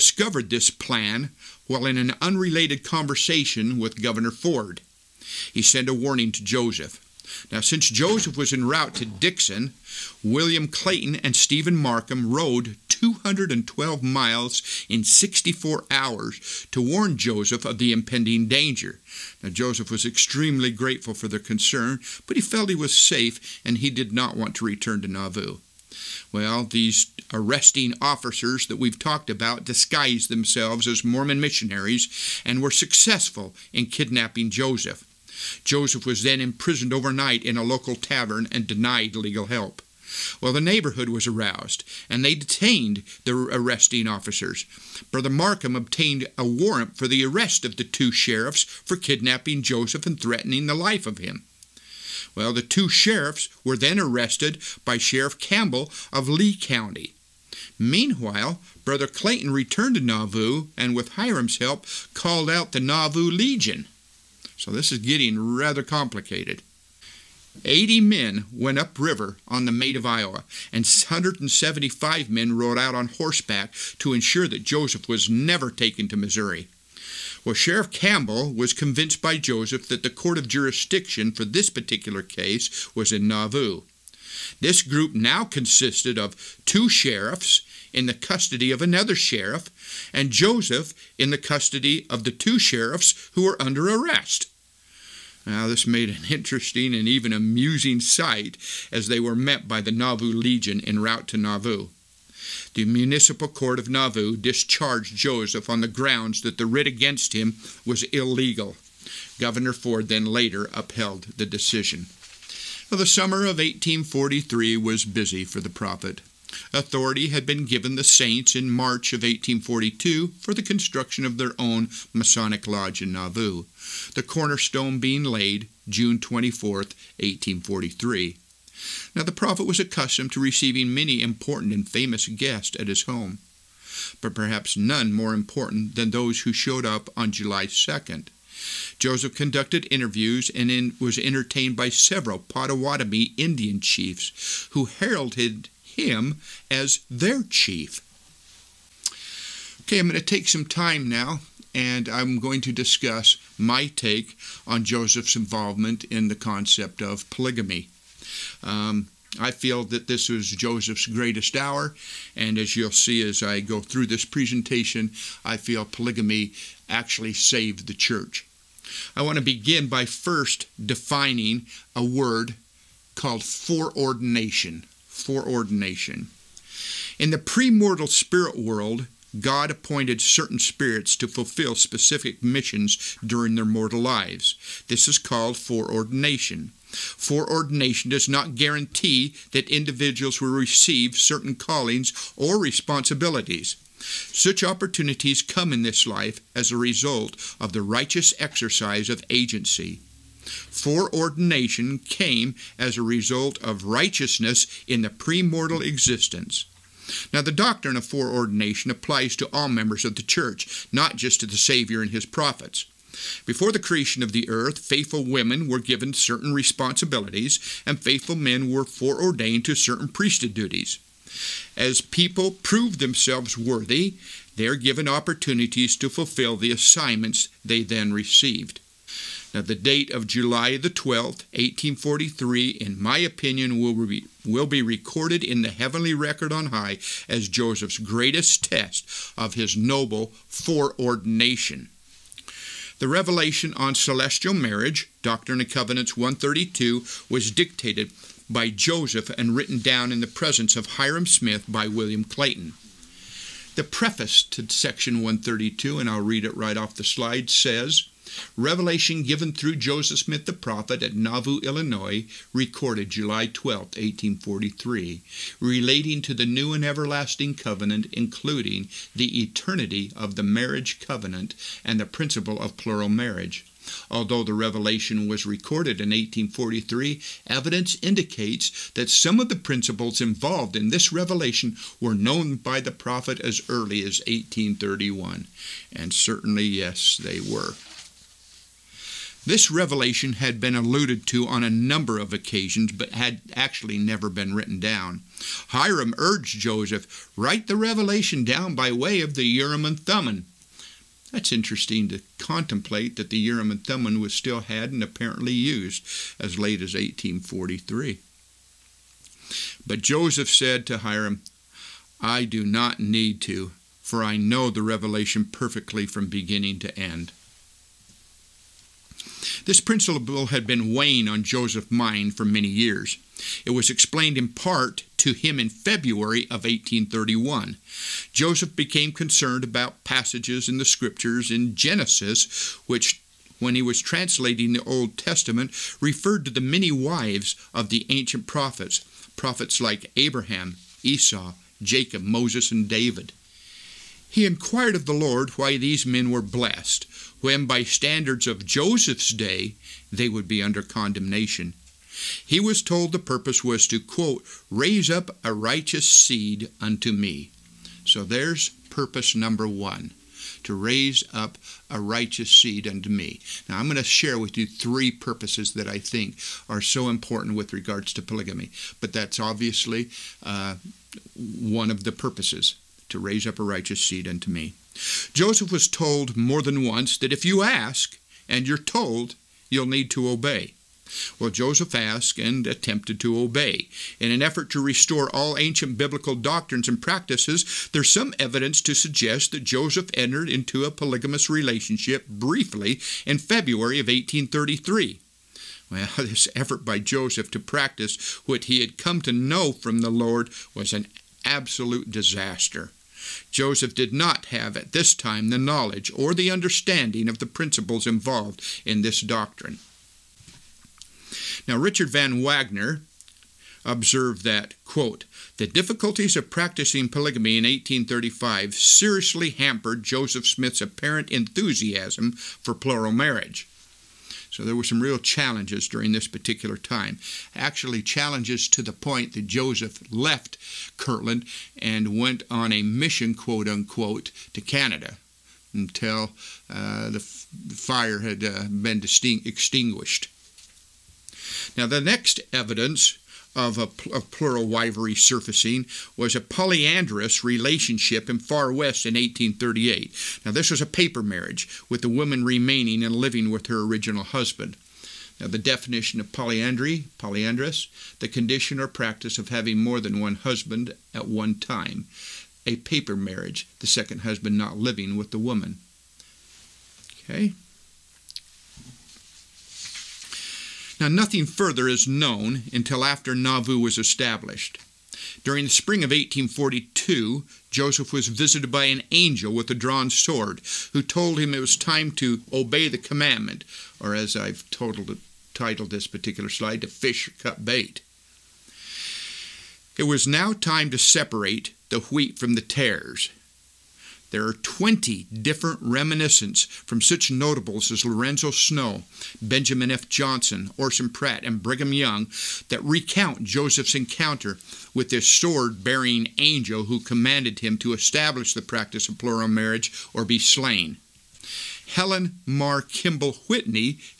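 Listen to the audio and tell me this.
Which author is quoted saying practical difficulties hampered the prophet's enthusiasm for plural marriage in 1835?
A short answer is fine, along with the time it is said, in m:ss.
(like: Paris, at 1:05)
Richard Van Wagoner, at 6:51.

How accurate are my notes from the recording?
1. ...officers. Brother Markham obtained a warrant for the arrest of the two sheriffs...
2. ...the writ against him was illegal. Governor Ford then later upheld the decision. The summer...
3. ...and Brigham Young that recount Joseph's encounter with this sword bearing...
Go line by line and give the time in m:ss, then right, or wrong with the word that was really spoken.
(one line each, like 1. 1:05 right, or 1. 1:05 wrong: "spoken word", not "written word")
1. 0:44 right
2. 1:46 right
3. 8:21 right.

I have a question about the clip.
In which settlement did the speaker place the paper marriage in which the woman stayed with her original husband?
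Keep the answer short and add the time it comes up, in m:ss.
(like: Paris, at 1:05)
Far West, at 7:28.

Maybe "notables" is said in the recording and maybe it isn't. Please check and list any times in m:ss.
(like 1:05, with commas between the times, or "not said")
8:17.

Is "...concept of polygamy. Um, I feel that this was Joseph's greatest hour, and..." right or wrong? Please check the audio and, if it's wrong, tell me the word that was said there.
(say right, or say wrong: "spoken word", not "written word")
right.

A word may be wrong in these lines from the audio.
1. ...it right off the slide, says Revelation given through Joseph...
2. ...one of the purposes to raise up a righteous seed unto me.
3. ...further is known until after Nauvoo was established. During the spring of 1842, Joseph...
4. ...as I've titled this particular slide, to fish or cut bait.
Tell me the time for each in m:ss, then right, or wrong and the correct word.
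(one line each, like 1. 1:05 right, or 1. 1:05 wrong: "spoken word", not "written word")
1. 4:16 right
2. 6:11 right
3. 7:51 right
4. 8:04 right.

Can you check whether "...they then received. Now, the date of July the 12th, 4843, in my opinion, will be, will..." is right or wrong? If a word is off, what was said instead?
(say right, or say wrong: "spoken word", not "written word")
wrong: "1843", not "4843".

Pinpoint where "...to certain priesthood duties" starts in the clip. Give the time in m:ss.
3:39.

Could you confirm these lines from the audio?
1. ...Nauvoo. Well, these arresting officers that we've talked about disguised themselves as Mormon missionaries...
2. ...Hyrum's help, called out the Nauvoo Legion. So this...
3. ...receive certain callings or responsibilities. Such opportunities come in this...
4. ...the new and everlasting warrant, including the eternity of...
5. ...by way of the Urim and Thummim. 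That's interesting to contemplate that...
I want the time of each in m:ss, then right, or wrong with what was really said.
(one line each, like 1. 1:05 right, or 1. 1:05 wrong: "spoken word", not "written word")
1. 0:25 right
2. 1:01 right
3. 3:10 right
4. 4:26 wrong: "covenant", not "warrant"
5. 4:58 right.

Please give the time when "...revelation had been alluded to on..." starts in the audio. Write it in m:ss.
4:49.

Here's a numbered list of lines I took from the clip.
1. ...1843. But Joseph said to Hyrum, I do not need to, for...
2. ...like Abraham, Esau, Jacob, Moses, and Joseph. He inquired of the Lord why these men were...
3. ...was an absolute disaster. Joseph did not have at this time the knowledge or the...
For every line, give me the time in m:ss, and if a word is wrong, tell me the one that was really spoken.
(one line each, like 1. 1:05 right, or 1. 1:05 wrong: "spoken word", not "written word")
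1. 5:06 right
2. 5:39 wrong: "David", not "Joseph"
3. 6:40 right.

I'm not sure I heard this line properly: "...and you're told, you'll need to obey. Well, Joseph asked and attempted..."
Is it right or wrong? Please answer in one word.
right.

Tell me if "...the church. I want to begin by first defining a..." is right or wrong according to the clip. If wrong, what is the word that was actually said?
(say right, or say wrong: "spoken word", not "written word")
right.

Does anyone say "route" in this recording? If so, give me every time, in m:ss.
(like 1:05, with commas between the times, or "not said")
0:08, 1:40.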